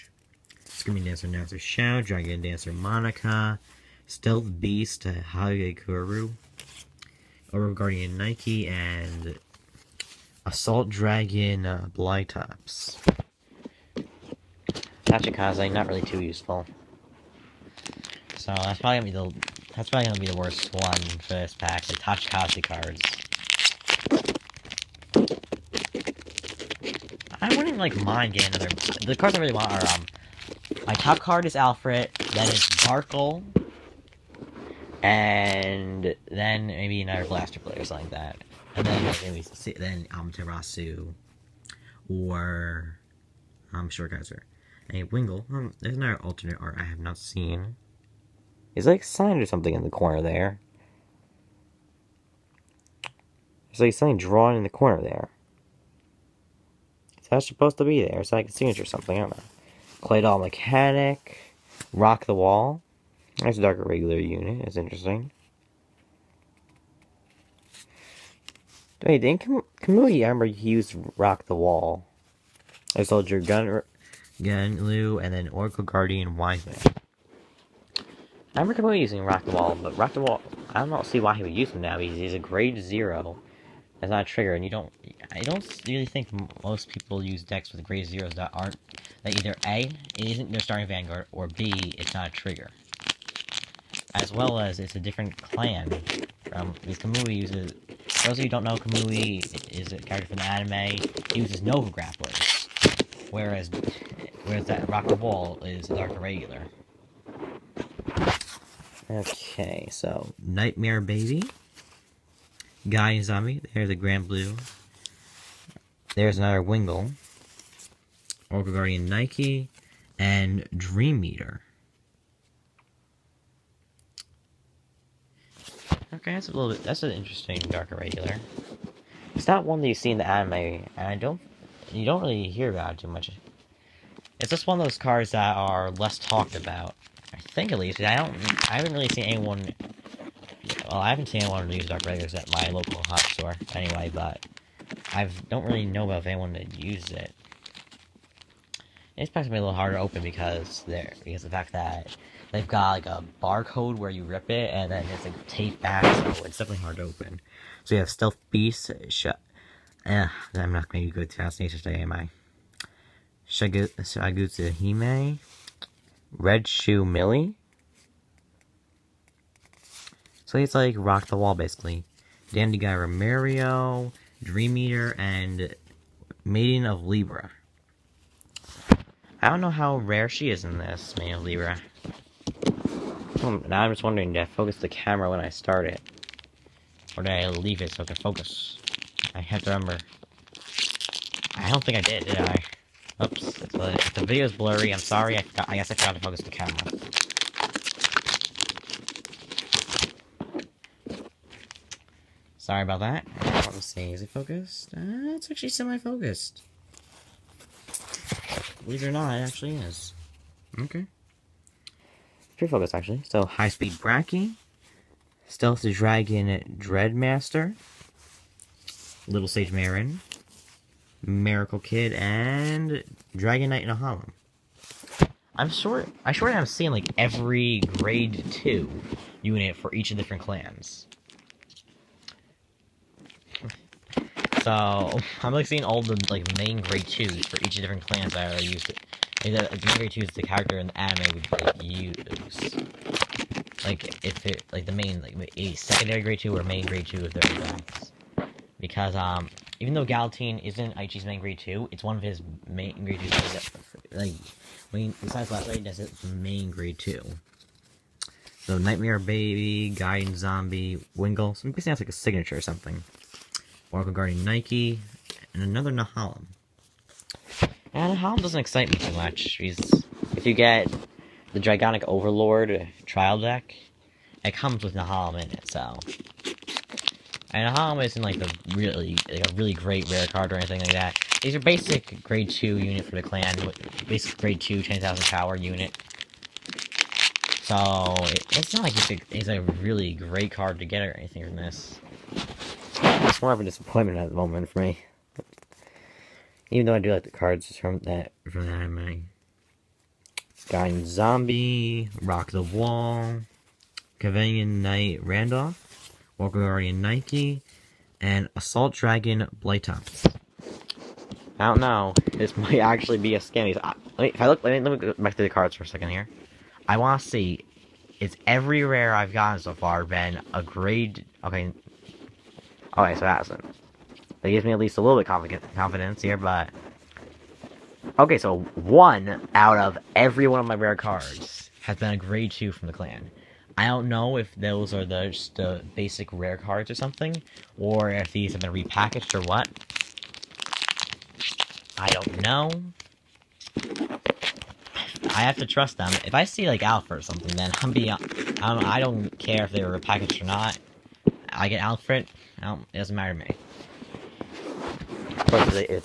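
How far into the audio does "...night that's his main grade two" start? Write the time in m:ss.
4:15.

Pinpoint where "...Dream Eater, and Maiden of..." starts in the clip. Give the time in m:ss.
2:54.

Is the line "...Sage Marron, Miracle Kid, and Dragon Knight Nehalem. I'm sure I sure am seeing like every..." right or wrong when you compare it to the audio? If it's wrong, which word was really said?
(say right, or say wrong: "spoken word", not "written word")
right.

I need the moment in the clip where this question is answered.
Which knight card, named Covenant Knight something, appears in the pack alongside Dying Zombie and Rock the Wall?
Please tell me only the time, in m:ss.
5:04.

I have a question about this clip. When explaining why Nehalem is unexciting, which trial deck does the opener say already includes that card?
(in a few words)
Dragonic Overlord.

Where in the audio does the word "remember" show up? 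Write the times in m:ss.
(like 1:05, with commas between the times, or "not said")
1:10, 1:18, 3:09.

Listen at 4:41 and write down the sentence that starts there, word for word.
These are basic grade 2 unit for the clan, basic grade 2 10,000 power unit.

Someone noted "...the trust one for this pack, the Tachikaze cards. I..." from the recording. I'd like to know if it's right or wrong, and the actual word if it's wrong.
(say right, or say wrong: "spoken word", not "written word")
wrong: "worst", not "trust".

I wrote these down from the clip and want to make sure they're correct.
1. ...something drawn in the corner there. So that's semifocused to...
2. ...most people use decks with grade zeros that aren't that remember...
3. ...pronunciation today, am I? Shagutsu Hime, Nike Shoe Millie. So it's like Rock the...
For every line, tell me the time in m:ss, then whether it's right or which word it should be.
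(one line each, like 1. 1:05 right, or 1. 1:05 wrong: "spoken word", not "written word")
1. 0:53 wrong: "supposed", not "semifocused"
2. 1:26 wrong: "either", not "remember"
3. 2:41 wrong: "Red", not "Nike".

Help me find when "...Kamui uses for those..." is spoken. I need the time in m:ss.
1:36.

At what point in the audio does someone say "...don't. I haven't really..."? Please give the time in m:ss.
2:18.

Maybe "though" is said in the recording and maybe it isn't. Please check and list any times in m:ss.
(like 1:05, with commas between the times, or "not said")
4:09, 4:56.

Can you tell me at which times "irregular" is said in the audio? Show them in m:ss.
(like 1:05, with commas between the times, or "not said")
1:03, 1:46, 2:07, 2:22.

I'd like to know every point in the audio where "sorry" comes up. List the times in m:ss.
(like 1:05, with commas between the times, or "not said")
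3:14, 3:22.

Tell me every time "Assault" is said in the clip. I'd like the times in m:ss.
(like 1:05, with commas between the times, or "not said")
0:10, 5:08.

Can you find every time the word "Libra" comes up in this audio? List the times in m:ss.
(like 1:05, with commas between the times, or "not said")
2:57, 3:01.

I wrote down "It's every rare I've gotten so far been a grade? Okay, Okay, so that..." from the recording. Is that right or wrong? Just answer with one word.
right.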